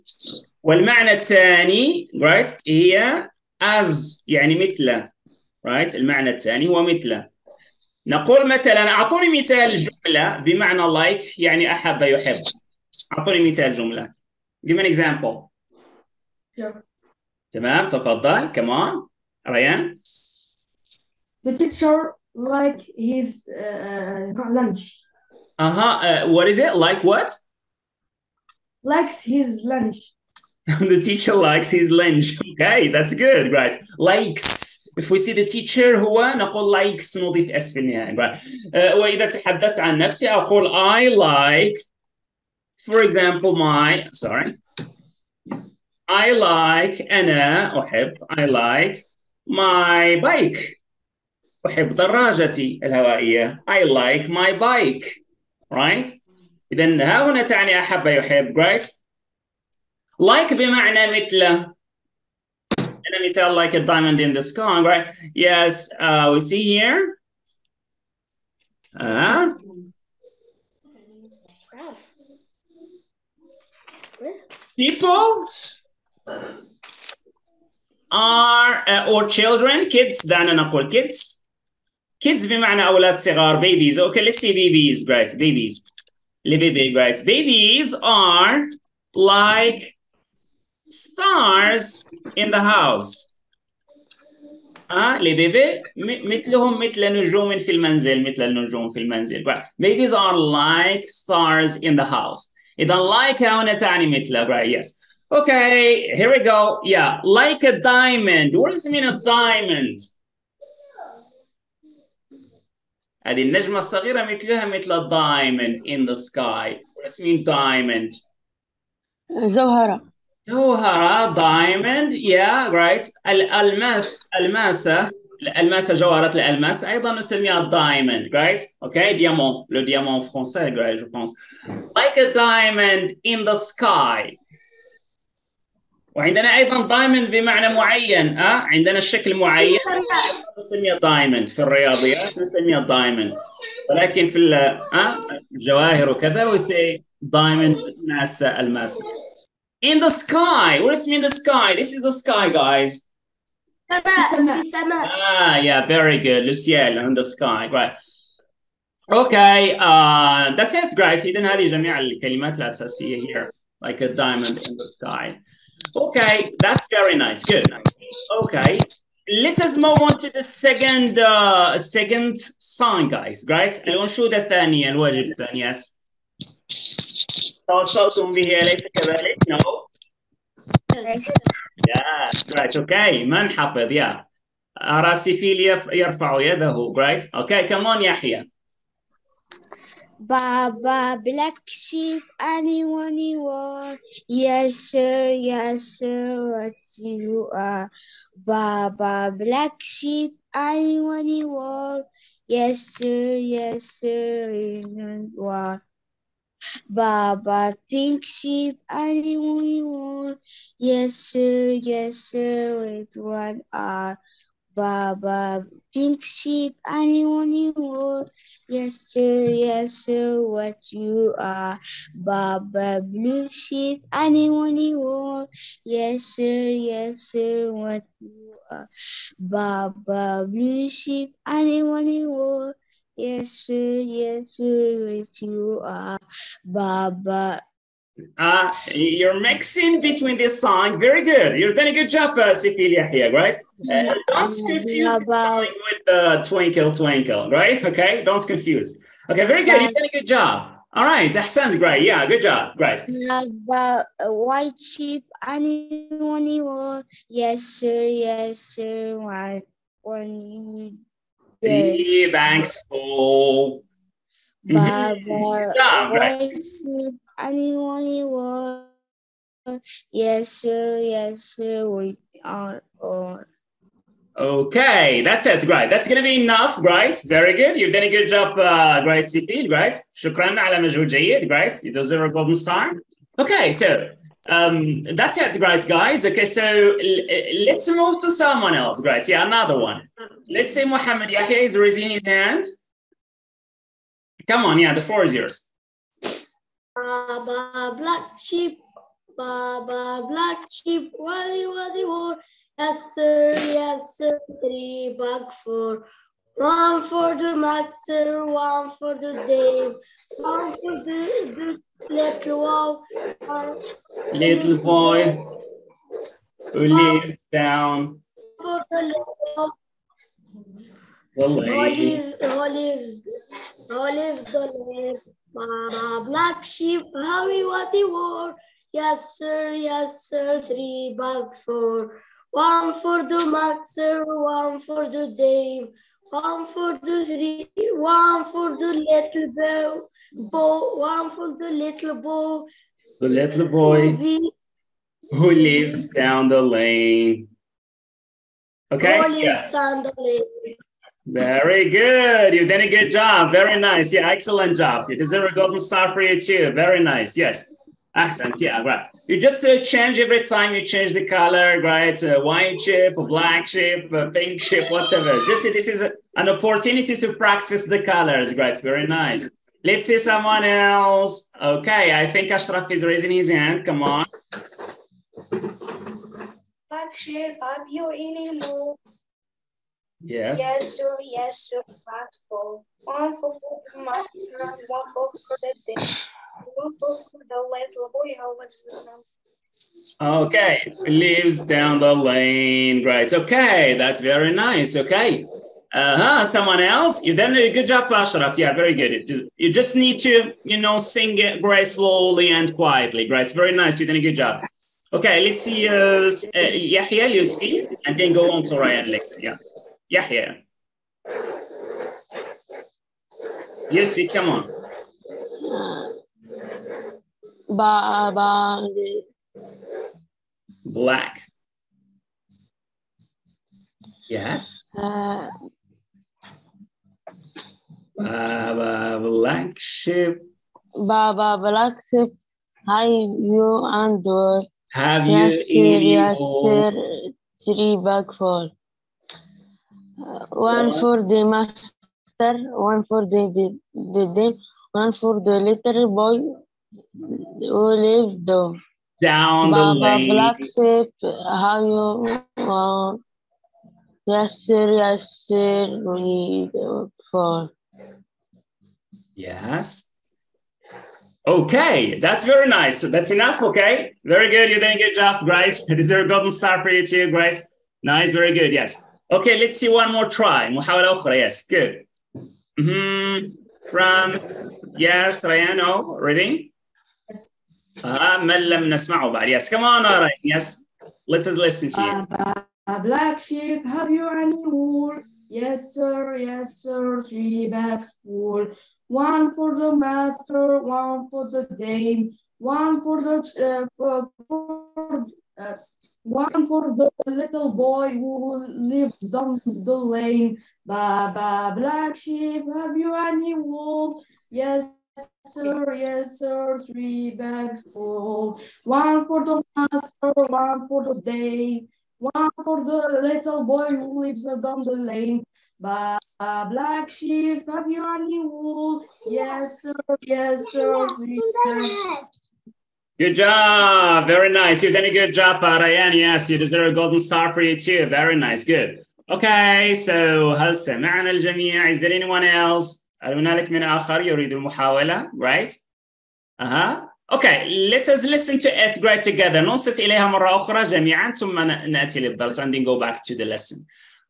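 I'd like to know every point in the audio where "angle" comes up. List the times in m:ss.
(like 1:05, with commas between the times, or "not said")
not said.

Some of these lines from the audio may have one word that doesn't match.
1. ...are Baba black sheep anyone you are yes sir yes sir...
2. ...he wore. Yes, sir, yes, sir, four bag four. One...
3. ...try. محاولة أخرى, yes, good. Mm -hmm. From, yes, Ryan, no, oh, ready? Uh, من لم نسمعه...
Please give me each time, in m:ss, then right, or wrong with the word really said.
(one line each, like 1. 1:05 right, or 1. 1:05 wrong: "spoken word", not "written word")
1. 3:17 right
2. 5:27 wrong: "three", not "four"
3. 7:50 right.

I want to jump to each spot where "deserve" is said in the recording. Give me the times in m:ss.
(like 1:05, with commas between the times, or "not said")
4:41, 5:55, 8:46.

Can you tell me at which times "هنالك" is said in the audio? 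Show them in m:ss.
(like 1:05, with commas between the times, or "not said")
8:53.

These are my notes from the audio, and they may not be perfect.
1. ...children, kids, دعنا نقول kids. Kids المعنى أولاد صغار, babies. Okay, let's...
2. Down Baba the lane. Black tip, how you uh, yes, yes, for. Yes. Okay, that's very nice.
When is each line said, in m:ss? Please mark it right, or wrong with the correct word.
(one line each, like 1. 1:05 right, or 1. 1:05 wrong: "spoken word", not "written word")
1. 1:19 wrong: "بمعنى", not "المعنى"
2. 7:29 right.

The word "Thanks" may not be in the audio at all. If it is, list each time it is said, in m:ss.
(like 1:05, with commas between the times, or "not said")
4:22.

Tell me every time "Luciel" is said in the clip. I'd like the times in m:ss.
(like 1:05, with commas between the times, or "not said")
2:36.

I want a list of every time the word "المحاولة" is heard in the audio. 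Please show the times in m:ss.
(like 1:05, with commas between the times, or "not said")
8:54.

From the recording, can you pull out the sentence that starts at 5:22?
Who lives, who lives the lake.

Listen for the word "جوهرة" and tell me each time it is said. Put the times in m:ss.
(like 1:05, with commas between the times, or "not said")
2:00, 2:05.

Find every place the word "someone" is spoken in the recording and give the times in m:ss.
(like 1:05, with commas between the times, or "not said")
4:48, 6:10, 6:36.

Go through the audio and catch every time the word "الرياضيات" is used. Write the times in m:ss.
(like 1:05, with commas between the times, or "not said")
2:21.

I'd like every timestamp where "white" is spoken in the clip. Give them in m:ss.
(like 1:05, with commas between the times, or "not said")
4:14, 6:02.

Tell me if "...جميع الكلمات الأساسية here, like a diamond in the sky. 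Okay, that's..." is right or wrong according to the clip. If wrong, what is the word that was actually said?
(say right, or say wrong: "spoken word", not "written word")
right.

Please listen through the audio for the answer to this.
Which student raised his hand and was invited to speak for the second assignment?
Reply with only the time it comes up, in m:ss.
4:50.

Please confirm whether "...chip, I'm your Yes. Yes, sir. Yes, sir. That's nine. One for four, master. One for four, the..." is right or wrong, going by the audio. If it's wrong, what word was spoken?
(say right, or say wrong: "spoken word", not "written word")
wrong: "four", not "nine".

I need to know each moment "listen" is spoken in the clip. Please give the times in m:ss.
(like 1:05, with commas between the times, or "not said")
8:01, 8:58.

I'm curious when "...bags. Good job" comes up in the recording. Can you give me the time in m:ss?
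8:41.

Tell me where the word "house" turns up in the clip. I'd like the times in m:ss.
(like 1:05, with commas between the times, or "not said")
1:32, 1:42.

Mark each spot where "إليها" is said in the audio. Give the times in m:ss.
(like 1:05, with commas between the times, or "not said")
9:00.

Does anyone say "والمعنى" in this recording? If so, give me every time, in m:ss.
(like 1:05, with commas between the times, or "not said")
0:00.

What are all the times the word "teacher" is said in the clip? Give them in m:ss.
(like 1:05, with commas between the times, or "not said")
0:21, 0:31, 0:35.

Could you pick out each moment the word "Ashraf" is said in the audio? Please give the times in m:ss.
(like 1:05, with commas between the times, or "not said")
6:12, 6:38.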